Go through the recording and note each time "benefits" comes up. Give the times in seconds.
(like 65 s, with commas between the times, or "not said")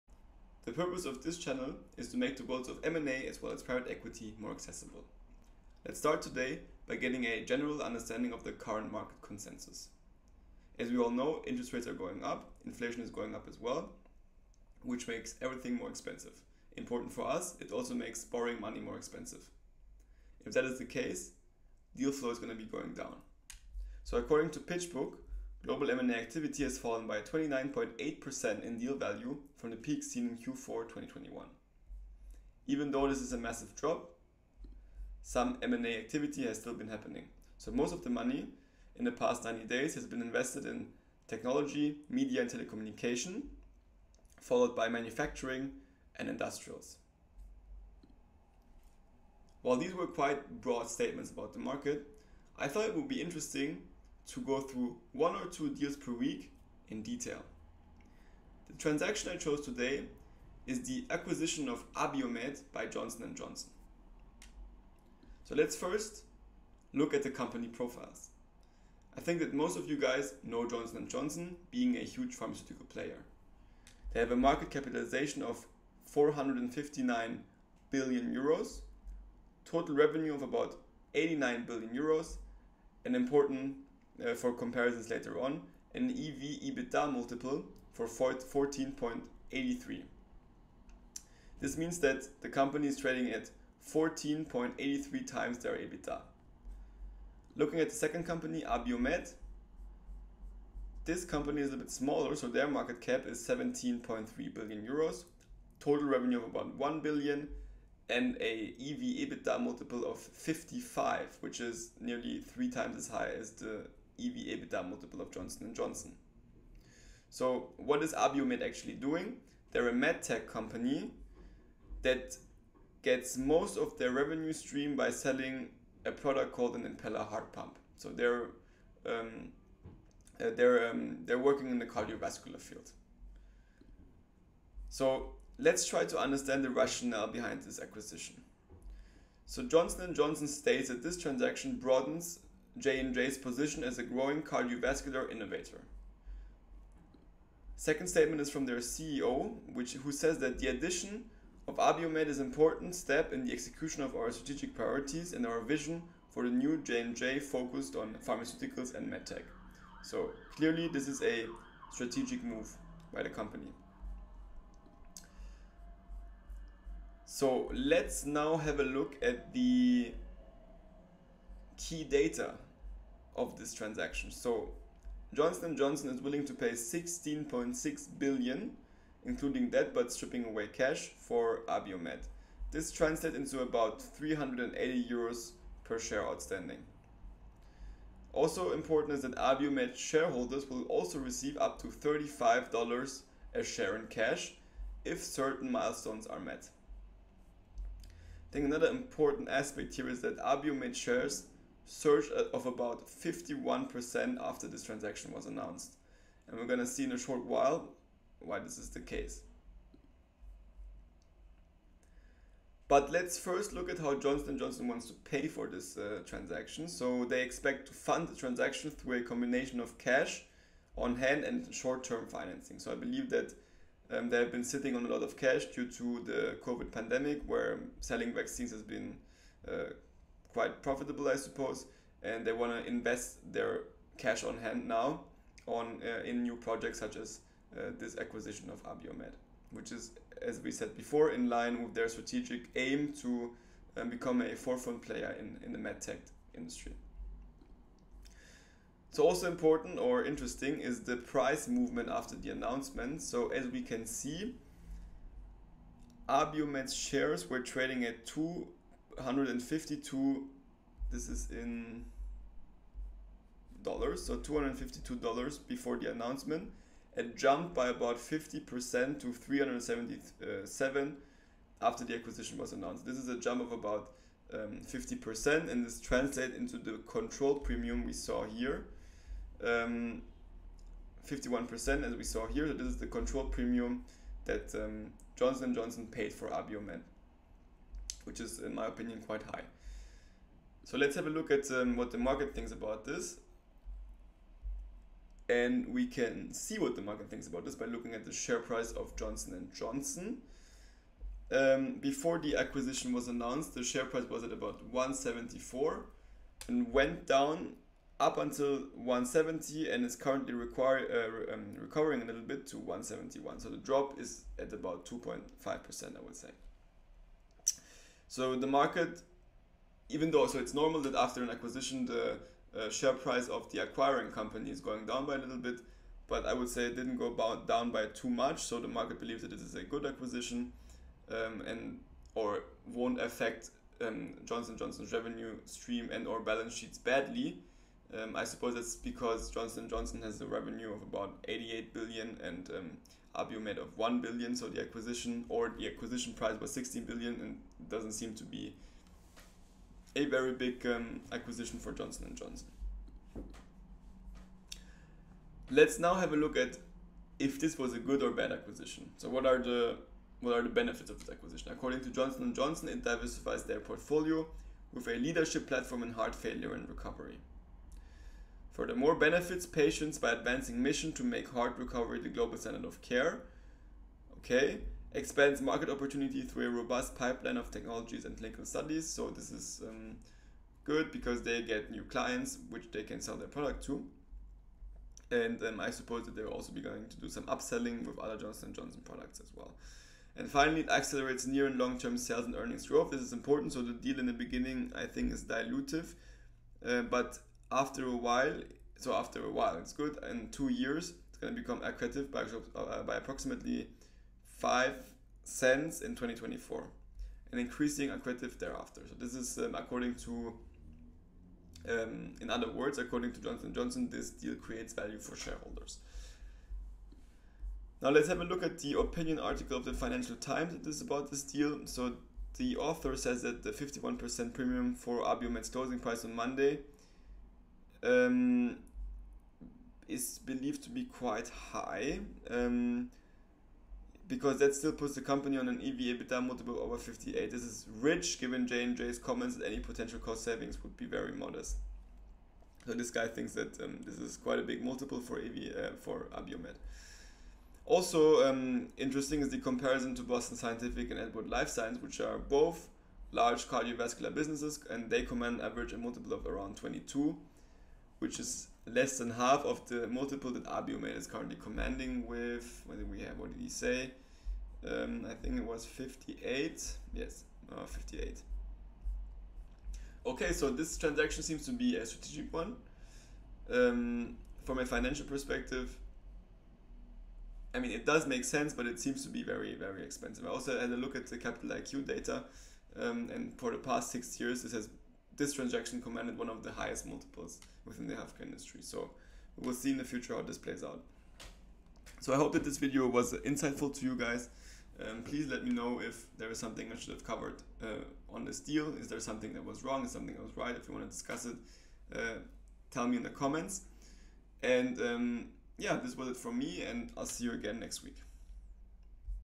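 360 s, 369 s.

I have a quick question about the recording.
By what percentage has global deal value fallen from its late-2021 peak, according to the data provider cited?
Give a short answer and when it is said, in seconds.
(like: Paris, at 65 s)
29.8%, at 27 s.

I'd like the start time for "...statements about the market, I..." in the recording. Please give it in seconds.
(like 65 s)
50 s.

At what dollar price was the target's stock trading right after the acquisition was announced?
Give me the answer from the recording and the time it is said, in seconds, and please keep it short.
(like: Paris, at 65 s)
$377, at 269 s.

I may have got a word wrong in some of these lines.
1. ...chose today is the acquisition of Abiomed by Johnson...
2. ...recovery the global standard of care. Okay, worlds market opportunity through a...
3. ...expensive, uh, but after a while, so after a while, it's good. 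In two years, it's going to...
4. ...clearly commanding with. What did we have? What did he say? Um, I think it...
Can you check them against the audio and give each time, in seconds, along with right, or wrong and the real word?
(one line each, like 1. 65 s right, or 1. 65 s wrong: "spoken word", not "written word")
1. 59 s right
2. 371 s wrong: "expands", not "worlds"
3. 395 s wrong: "dilutive", not "expensive"
4. 461 s wrong: "currently", not "clearly".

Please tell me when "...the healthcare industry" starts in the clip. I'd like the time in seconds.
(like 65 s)
488 s.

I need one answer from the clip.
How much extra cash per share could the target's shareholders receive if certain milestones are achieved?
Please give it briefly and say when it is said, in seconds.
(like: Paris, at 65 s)
$35, at 191 s.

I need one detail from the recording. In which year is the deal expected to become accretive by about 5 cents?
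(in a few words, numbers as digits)
2024.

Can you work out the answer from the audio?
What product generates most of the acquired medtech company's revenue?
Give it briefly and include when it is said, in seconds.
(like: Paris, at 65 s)
Impella heart pump, at 126 s.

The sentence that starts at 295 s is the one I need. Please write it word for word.
And we can see what the market thinks about this by looking at the share price of Johnson & Johnson.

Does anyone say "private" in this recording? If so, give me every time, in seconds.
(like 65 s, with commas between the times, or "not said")
3 s.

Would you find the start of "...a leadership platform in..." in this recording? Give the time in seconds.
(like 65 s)
365 s.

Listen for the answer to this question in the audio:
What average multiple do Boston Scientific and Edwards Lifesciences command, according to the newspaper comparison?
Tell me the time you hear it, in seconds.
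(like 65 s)
456 s.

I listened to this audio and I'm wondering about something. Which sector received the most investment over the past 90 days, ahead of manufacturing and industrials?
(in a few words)
technology, media and telecommunication.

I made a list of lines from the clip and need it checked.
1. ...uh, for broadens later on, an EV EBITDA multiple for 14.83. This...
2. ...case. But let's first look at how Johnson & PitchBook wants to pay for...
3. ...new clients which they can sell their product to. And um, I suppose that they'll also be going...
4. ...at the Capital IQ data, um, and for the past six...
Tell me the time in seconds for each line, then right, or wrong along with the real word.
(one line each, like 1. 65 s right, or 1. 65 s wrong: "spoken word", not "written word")
1. 84 s wrong: "comparisons", not "broadens"
2. 209 s wrong: "Johnson", not "PitchBook"
3. 381 s right
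4. 481 s right.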